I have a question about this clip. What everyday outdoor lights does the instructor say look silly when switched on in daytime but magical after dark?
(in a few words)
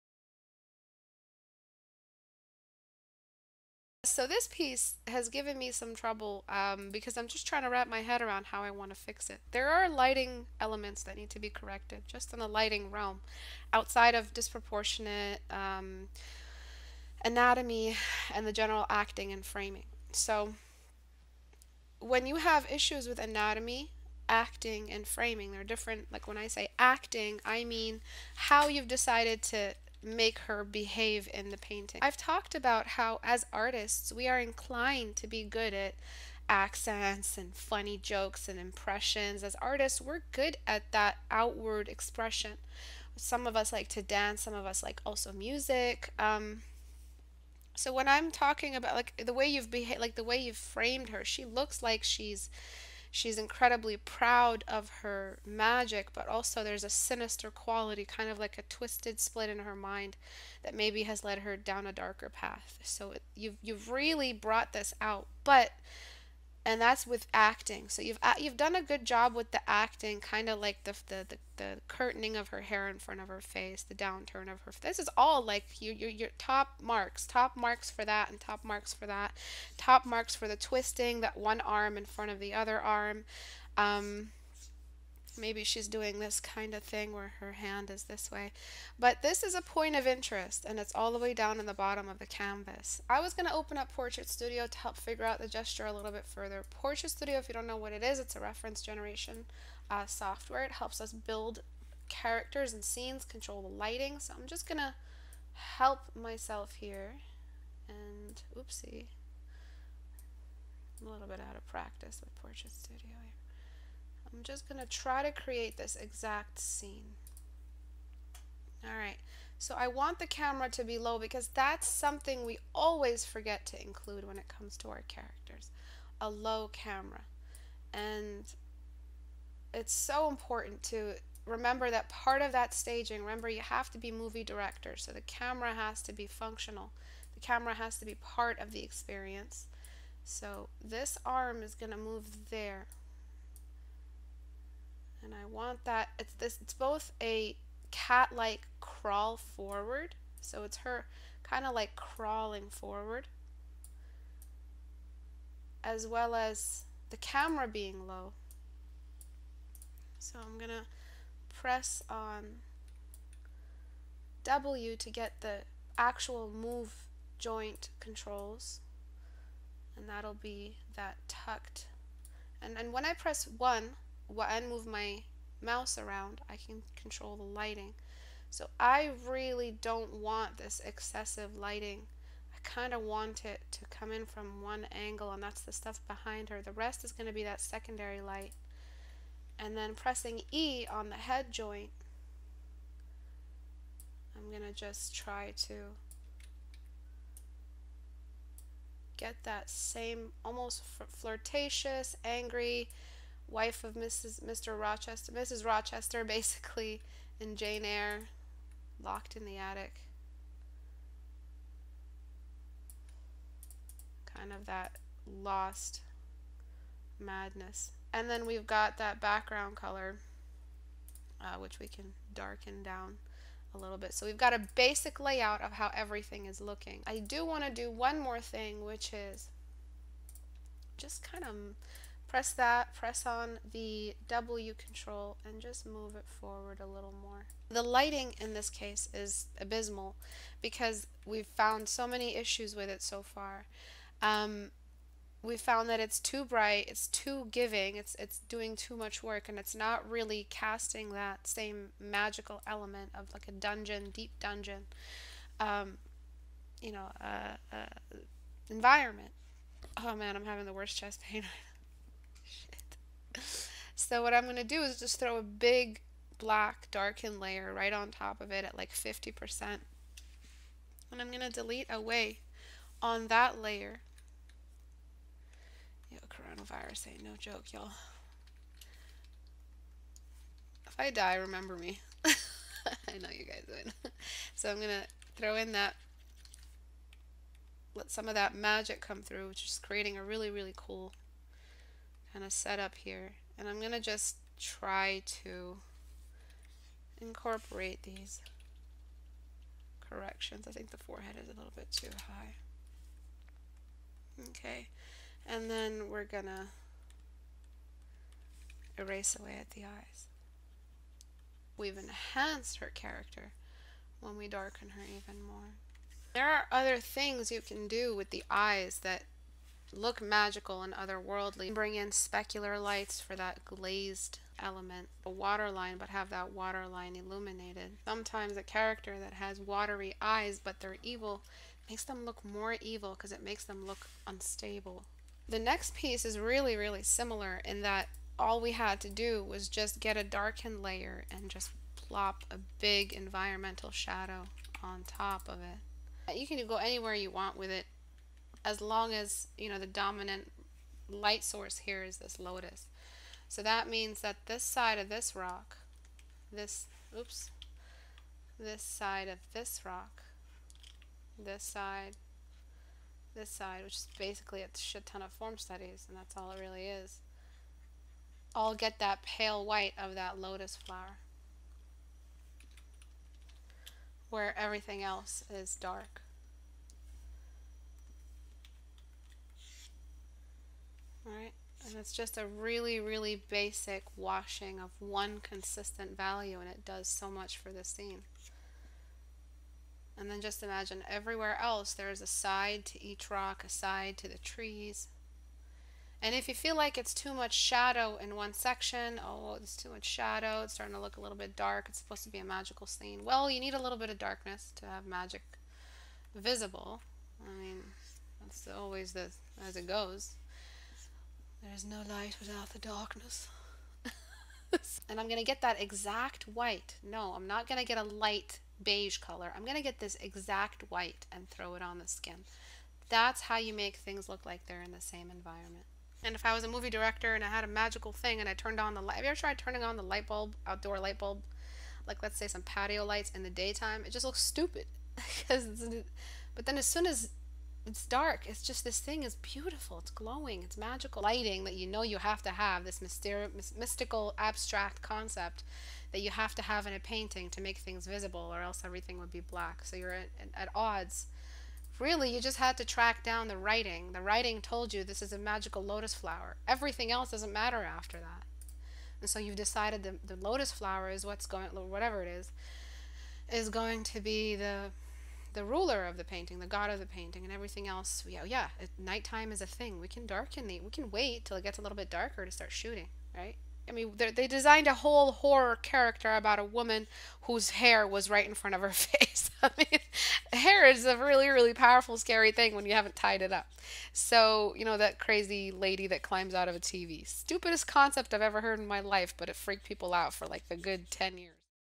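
patio lights.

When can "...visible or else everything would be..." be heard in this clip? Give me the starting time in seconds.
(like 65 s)
448 s.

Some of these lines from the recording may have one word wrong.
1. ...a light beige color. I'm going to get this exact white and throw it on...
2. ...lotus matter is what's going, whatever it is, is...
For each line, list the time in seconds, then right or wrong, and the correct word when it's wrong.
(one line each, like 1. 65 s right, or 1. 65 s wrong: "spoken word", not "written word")
1. 417 s right
2. 460 s wrong: "flower", not "matter".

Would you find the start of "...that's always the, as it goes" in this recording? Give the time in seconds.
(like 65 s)
408 s.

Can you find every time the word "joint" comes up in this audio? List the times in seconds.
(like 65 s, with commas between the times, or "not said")
167 s, 191 s.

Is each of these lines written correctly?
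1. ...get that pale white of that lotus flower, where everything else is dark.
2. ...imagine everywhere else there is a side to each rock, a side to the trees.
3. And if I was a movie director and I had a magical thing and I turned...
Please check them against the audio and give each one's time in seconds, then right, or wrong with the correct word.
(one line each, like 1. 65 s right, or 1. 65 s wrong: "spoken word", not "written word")
1. 368 s right
2. 390 s right
3. 426 s right.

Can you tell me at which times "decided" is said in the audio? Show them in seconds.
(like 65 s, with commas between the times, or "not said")
28 s, 459 s.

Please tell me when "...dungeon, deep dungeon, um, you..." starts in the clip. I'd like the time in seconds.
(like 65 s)
253 s.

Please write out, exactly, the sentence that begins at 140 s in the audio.
So this arm is going to move there.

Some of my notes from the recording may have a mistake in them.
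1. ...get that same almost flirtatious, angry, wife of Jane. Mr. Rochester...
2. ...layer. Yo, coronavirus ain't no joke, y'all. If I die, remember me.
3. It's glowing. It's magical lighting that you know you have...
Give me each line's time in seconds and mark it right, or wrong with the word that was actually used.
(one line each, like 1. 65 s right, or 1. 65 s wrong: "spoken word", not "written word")
1. 199 s wrong: "Mrs", not "Jane"
2. 273 s right
3. 439 s right.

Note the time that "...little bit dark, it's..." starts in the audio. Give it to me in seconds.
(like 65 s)
401 s.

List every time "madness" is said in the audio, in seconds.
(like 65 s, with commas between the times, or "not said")
217 s.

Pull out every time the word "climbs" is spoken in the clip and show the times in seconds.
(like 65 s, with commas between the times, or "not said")
486 s.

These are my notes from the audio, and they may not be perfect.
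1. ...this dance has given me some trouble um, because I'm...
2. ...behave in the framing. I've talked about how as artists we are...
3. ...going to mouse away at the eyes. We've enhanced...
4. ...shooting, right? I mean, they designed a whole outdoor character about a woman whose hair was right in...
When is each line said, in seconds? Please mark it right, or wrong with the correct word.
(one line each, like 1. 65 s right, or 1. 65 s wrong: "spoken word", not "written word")
1. 4 s wrong: "piece", not "dance"
2. 30 s wrong: "painting", not "framing"
3. 306 s wrong: "erase", not "mouse"
4. 472 s wrong: "horror", not "outdoor".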